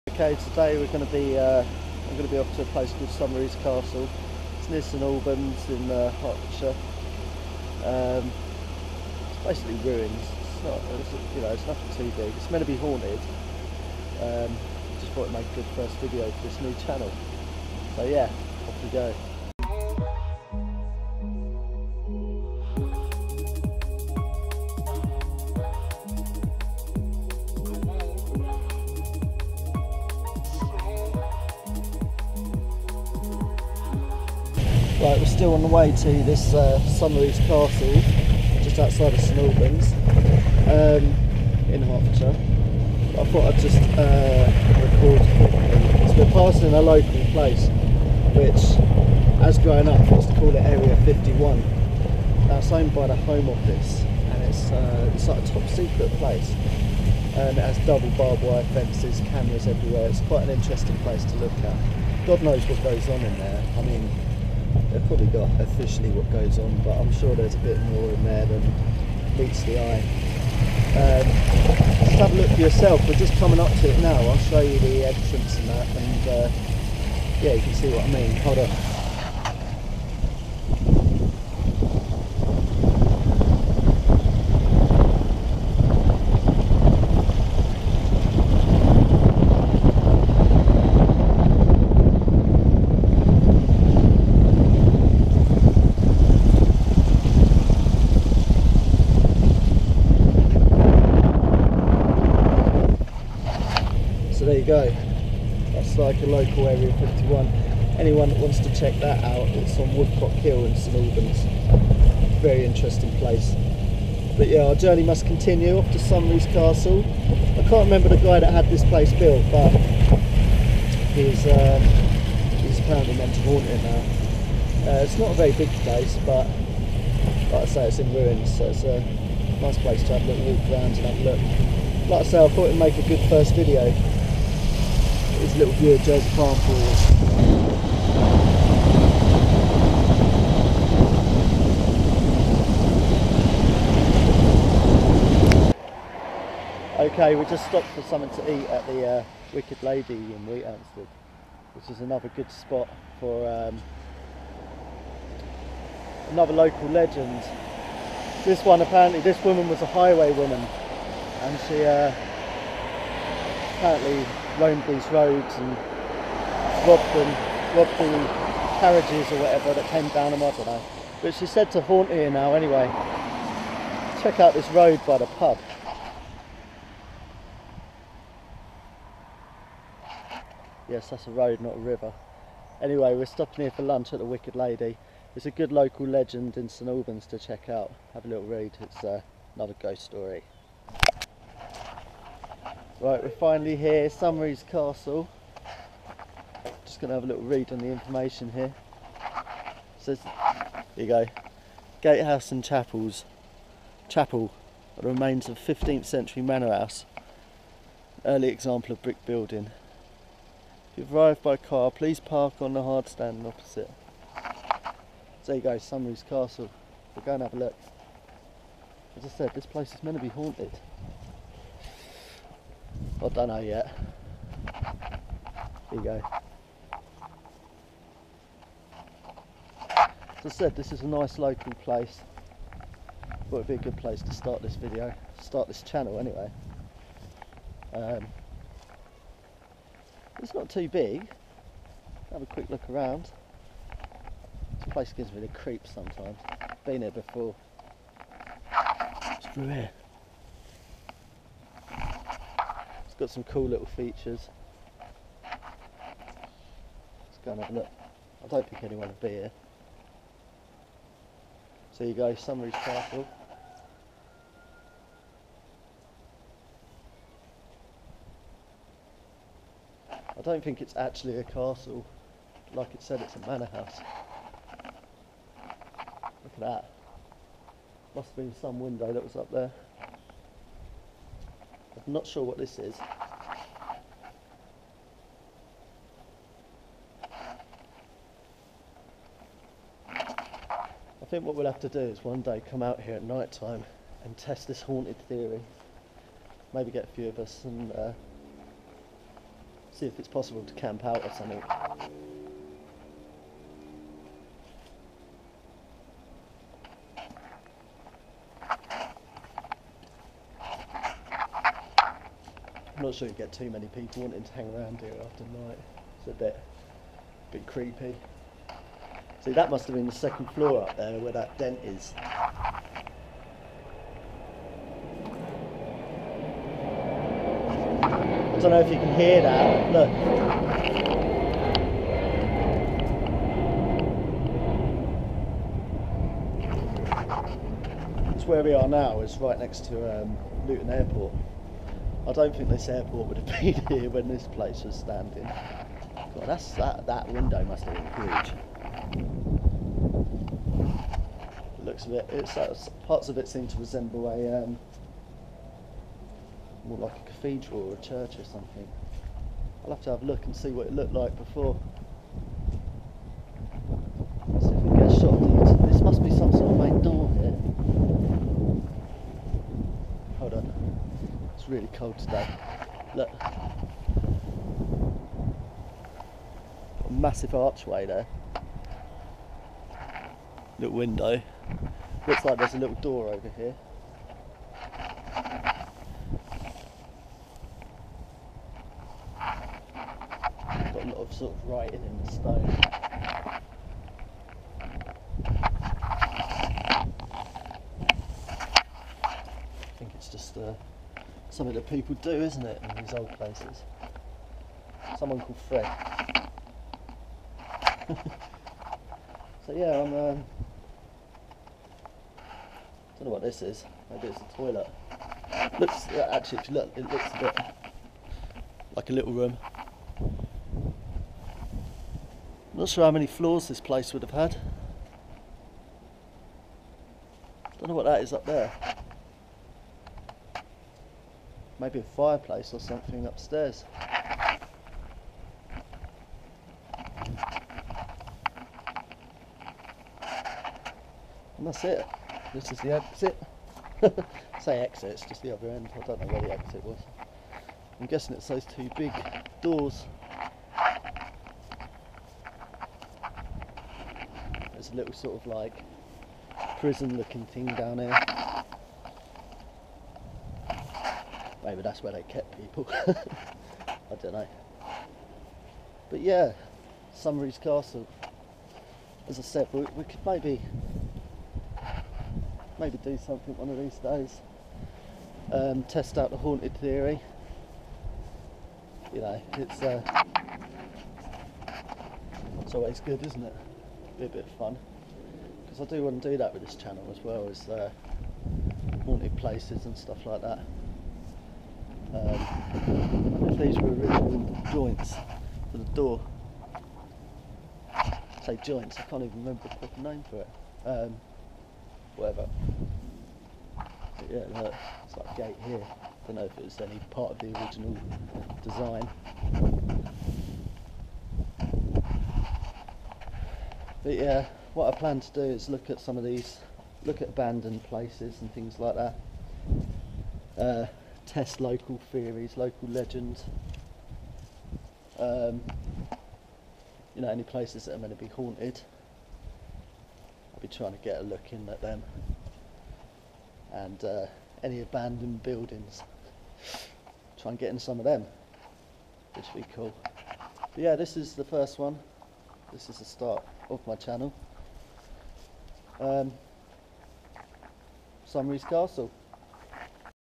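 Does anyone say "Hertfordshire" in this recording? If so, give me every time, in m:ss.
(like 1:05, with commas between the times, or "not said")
0:06, 0:41.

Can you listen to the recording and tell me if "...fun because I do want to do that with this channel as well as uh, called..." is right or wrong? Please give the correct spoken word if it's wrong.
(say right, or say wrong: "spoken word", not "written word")
wrong: "haunted", not "called".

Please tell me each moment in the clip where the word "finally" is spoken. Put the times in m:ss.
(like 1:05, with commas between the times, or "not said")
3:13.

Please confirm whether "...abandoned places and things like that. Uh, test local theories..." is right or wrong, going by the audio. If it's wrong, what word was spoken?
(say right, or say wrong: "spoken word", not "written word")
right.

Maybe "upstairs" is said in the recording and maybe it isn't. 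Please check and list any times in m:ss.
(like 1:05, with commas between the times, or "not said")
7:13.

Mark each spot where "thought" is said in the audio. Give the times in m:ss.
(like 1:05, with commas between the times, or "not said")
0:15, 0:43, 2:12.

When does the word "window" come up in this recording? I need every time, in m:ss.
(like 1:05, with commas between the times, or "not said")
4:38, 5:47, 6:20.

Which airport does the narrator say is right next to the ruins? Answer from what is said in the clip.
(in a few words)
Luton Airport.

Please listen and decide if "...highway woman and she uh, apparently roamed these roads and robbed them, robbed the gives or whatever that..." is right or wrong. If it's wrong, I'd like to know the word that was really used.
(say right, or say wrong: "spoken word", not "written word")
wrong: "carriages", not "gives".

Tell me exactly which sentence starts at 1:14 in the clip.
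I'll show you the entrance and that, and uh, yeah, you can see what I mean.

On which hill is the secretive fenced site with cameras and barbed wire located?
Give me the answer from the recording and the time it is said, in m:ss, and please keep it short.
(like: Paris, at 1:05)
Woodcock Hill, at 1:49.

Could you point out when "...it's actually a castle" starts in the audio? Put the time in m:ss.
4:30.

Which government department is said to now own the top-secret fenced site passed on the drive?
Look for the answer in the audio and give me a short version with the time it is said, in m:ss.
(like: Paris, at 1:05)
Home Office, at 0:53.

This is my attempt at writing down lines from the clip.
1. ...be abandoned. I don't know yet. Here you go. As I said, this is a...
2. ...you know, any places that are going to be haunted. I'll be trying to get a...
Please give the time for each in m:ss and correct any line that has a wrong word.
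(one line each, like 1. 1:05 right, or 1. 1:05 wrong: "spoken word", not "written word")
1. 3:40 wrong: "haunted", not "abandoned"
2. 8:47 right.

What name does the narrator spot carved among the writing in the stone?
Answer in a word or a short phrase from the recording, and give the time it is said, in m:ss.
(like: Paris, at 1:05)
Fred, at 6:45.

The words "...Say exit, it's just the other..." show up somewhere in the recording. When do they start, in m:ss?
7:24.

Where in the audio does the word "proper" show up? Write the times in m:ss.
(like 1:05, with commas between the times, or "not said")
8:19.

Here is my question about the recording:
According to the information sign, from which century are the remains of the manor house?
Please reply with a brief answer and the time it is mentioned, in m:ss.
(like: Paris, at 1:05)
15th century, at 3:25.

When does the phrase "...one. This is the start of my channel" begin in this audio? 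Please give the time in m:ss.
9:01.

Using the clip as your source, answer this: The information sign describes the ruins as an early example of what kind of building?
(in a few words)
Brick building.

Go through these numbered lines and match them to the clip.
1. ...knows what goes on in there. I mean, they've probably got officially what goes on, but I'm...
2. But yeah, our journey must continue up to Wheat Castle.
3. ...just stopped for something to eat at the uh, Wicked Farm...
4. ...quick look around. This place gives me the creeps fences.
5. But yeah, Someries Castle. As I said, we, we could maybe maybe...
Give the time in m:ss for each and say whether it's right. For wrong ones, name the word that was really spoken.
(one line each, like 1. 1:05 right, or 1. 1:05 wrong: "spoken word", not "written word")
1. 1:02 right
2. 1:54 wrong: "Someries", not "Wheat"
3. 2:27 wrong: "Lady", not "Farm"
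4. 4:02 wrong: "sometimes", not "fences"
5. 7:46 right.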